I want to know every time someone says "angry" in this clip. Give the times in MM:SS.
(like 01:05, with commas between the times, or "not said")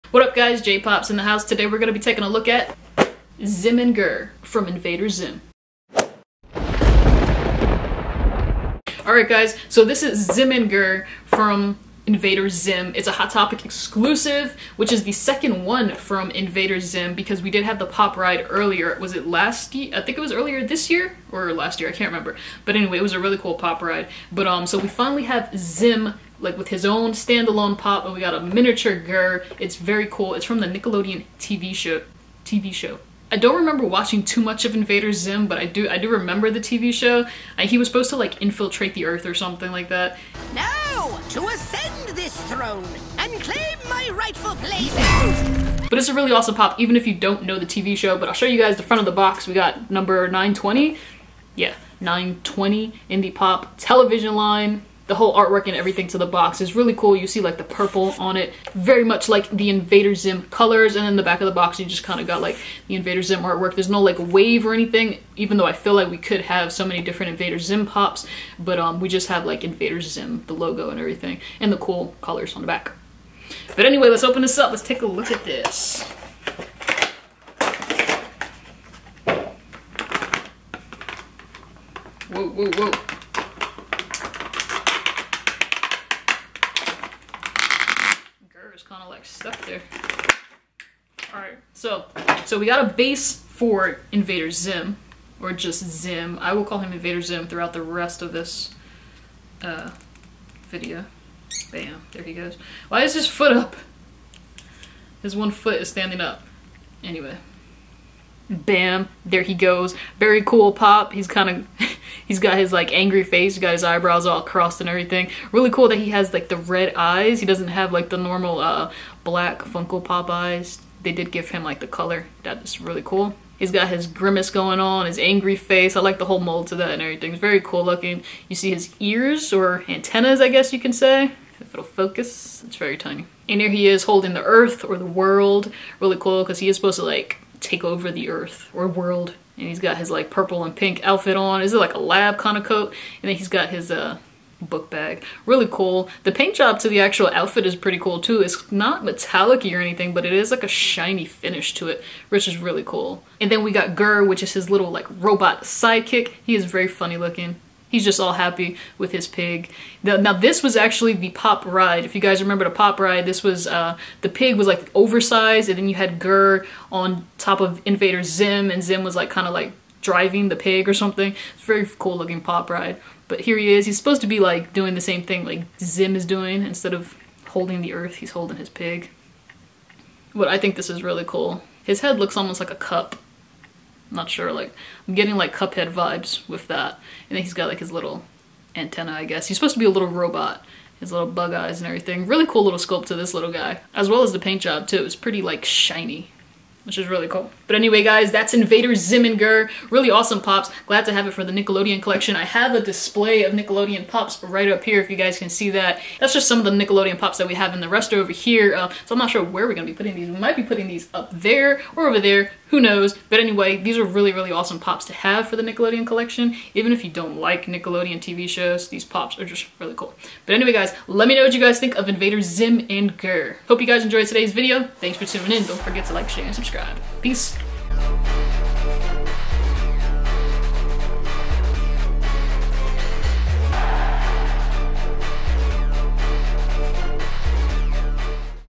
01:52, 02:05.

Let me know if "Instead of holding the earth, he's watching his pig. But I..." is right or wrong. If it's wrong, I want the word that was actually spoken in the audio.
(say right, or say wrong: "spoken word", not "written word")
wrong: "holding", not "watching".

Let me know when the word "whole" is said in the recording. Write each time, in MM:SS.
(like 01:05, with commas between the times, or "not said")
00:55, 02:06.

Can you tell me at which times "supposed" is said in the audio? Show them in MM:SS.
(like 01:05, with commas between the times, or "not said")
00:37, 02:16, 02:53, 03:09.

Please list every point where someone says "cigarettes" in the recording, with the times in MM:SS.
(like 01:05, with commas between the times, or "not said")
not said.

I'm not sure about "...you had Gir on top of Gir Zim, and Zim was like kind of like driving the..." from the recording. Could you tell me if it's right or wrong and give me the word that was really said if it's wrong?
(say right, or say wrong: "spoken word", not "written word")
wrong: "Invader", not "Gir".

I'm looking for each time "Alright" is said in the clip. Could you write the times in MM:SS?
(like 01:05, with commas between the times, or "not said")
00:09, 01:31.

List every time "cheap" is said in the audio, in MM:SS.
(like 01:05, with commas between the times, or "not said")
not said.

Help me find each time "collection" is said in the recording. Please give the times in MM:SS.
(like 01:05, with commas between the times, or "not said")
03:22, 03:36.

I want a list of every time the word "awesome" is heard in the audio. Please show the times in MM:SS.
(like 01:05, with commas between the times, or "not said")
00:46, 03:20, 03:34.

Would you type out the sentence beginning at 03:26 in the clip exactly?
That's just some of the Nickelodeon pops that we have in the rest over here.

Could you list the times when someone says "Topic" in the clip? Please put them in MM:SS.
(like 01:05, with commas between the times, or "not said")
00:13.